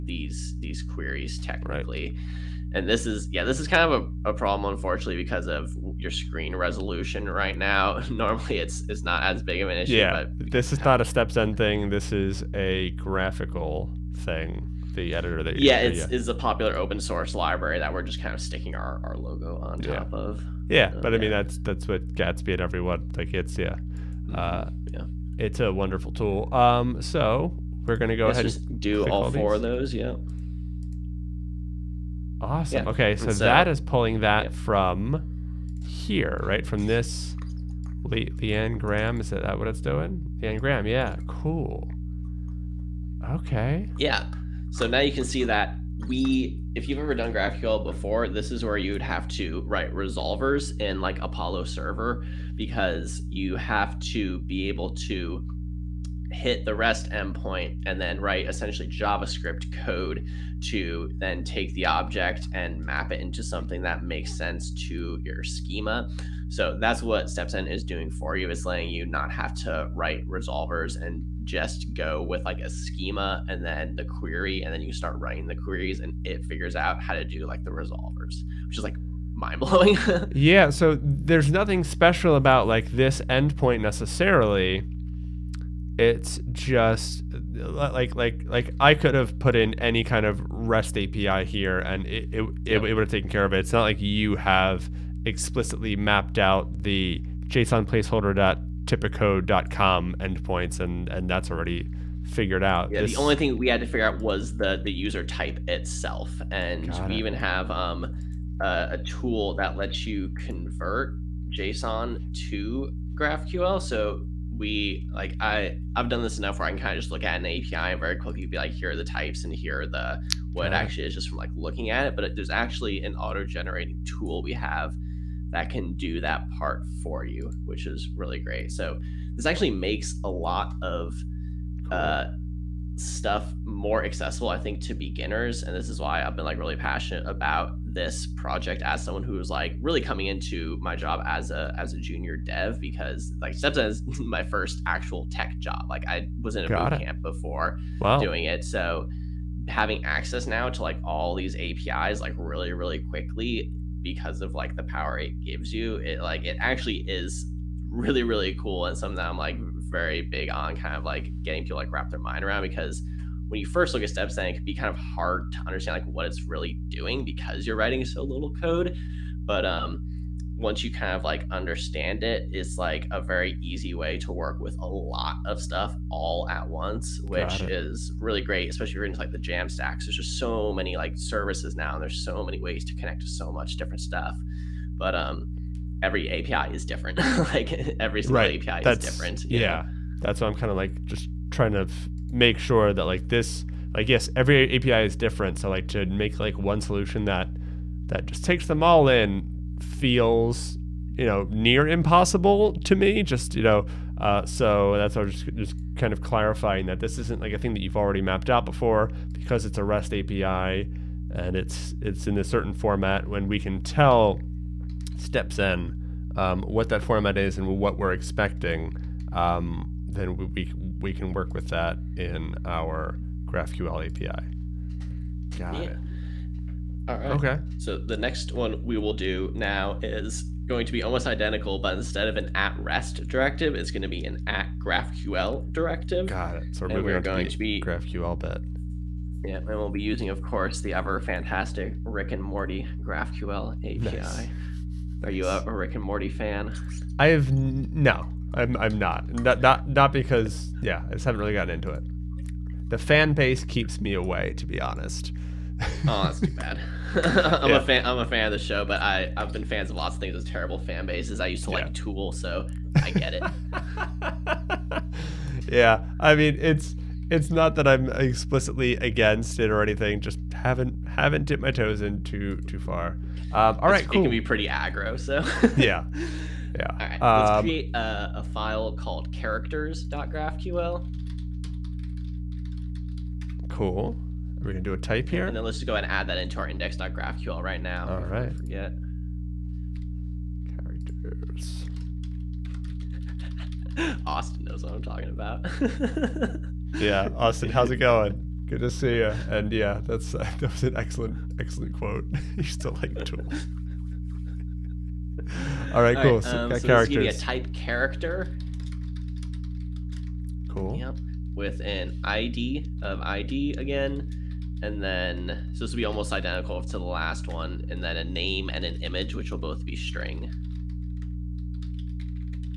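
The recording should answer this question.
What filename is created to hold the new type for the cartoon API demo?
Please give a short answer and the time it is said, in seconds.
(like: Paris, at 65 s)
characters.graphql, at 279 s.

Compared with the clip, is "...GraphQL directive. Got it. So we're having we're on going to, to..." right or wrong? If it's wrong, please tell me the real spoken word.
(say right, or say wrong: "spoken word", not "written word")
wrong: "moving", not "having".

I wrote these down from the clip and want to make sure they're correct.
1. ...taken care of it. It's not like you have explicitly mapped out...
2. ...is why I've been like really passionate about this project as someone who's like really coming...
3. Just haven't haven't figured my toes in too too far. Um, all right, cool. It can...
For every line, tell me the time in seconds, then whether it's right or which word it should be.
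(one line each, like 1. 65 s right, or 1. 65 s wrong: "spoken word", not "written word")
1. 93 s right
2. 135 s right
3. 270 s wrong: "dipped", not "figured".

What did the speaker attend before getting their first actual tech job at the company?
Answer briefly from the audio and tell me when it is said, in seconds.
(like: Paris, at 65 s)
a boot camp, at 146 s.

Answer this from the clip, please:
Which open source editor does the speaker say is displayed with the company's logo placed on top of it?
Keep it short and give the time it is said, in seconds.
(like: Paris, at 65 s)
GraphiQL, at 13 s.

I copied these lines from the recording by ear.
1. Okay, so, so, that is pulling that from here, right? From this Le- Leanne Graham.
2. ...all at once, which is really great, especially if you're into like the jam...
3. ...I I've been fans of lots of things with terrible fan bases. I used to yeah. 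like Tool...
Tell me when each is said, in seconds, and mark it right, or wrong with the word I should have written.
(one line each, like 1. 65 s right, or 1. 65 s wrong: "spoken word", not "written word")
1. 32 s right
2. 176 s right
3. 259 s right.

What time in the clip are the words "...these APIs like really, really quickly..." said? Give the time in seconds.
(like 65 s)
151 s.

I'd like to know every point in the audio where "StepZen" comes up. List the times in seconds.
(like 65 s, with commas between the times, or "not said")
11 s, 67 s, 143 s, 164 s, 215 s.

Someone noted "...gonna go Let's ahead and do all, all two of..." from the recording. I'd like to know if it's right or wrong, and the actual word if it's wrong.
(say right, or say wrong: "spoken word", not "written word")
wrong: "four", not "two".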